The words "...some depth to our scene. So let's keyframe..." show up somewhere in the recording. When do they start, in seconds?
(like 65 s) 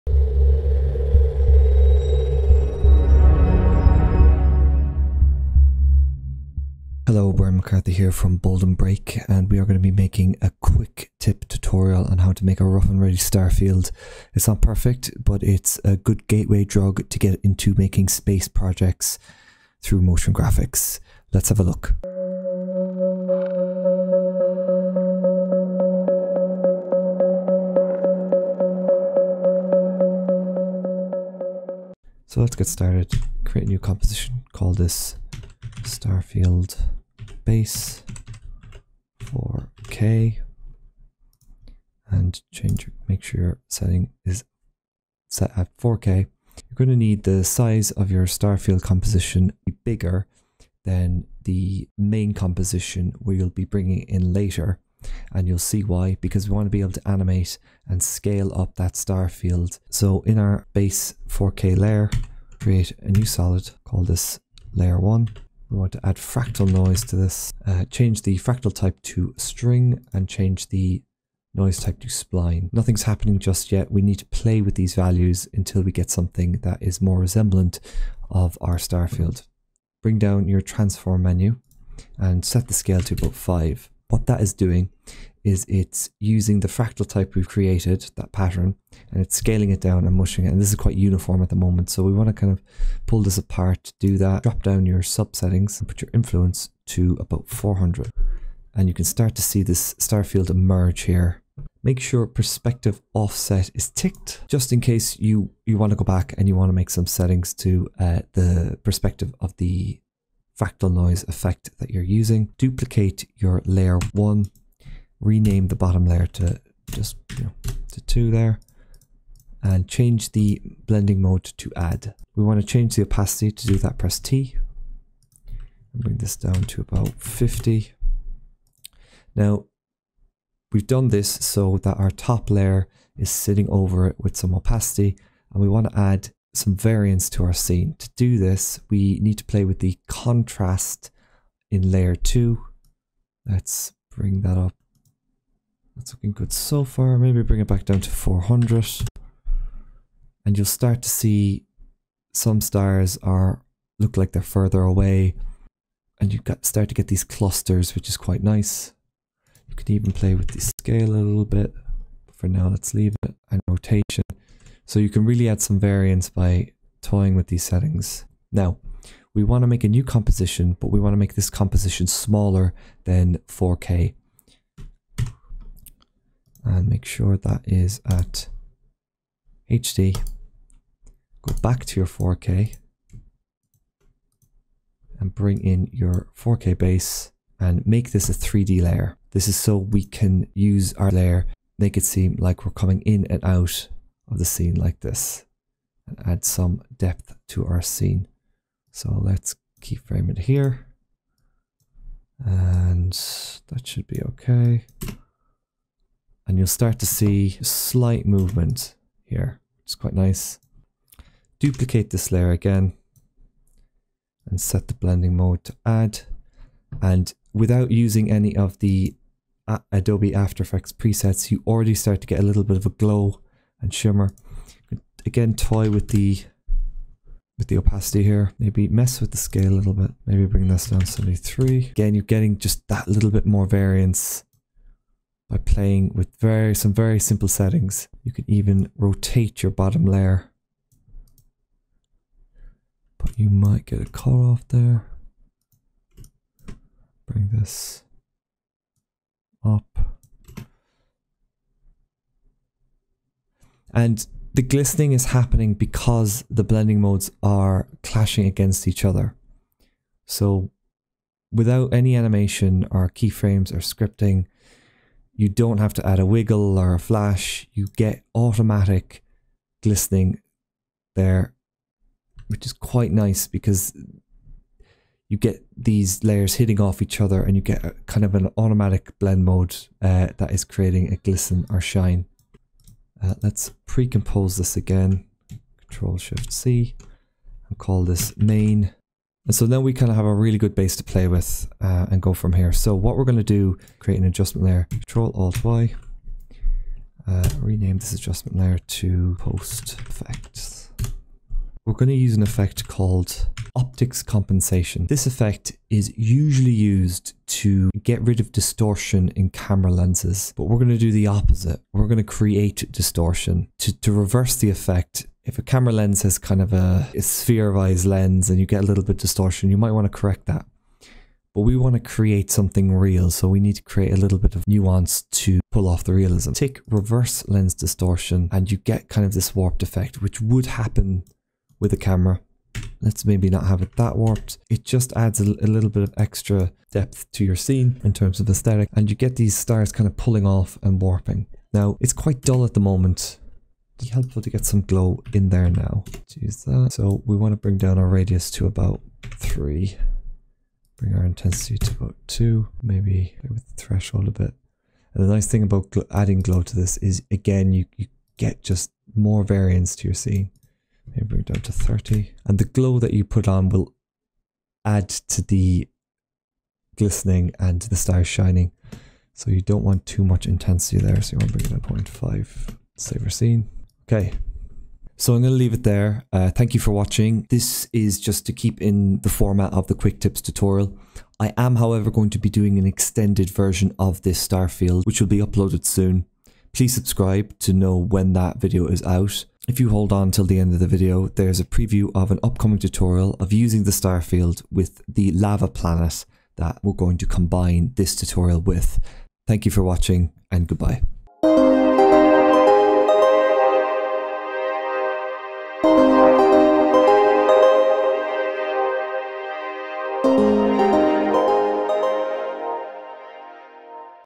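196 s.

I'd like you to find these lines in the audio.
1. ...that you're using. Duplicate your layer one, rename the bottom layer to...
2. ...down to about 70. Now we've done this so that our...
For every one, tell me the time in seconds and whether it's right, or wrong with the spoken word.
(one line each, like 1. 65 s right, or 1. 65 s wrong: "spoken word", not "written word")
1. 111 s right
2. 126 s wrong: "50", not "70".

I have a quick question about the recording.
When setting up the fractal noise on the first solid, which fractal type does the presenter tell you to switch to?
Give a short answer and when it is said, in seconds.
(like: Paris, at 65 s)
String, at 69 s.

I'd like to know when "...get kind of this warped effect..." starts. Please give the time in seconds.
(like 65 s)
328 s.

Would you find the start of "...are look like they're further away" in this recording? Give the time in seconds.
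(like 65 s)
153 s.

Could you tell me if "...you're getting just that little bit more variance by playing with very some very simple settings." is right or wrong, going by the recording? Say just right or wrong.
right.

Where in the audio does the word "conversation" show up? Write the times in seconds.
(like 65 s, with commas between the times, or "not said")
not said.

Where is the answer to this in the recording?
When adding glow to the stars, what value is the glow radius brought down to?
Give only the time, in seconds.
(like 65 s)
348 s.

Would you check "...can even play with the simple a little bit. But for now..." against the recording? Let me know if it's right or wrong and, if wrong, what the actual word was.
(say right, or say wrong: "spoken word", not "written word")
wrong: "scale", not "simple".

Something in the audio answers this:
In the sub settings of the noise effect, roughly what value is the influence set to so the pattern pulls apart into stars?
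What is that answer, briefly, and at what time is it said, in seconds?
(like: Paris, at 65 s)
400, at 97 s.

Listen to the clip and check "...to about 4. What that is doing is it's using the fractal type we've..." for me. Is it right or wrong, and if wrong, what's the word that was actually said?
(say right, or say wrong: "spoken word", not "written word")
wrong: "5", not "4".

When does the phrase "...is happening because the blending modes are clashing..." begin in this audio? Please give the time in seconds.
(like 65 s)
255 s.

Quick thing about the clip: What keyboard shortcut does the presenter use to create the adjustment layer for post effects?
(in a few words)
Control Alt Y.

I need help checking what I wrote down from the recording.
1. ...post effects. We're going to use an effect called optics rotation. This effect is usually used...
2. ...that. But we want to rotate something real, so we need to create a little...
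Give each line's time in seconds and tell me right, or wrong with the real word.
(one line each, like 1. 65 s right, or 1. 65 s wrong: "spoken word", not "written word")
1. 299 s wrong: "compensation", not "rotation"
2. 320 s wrong: "create", not "rotate".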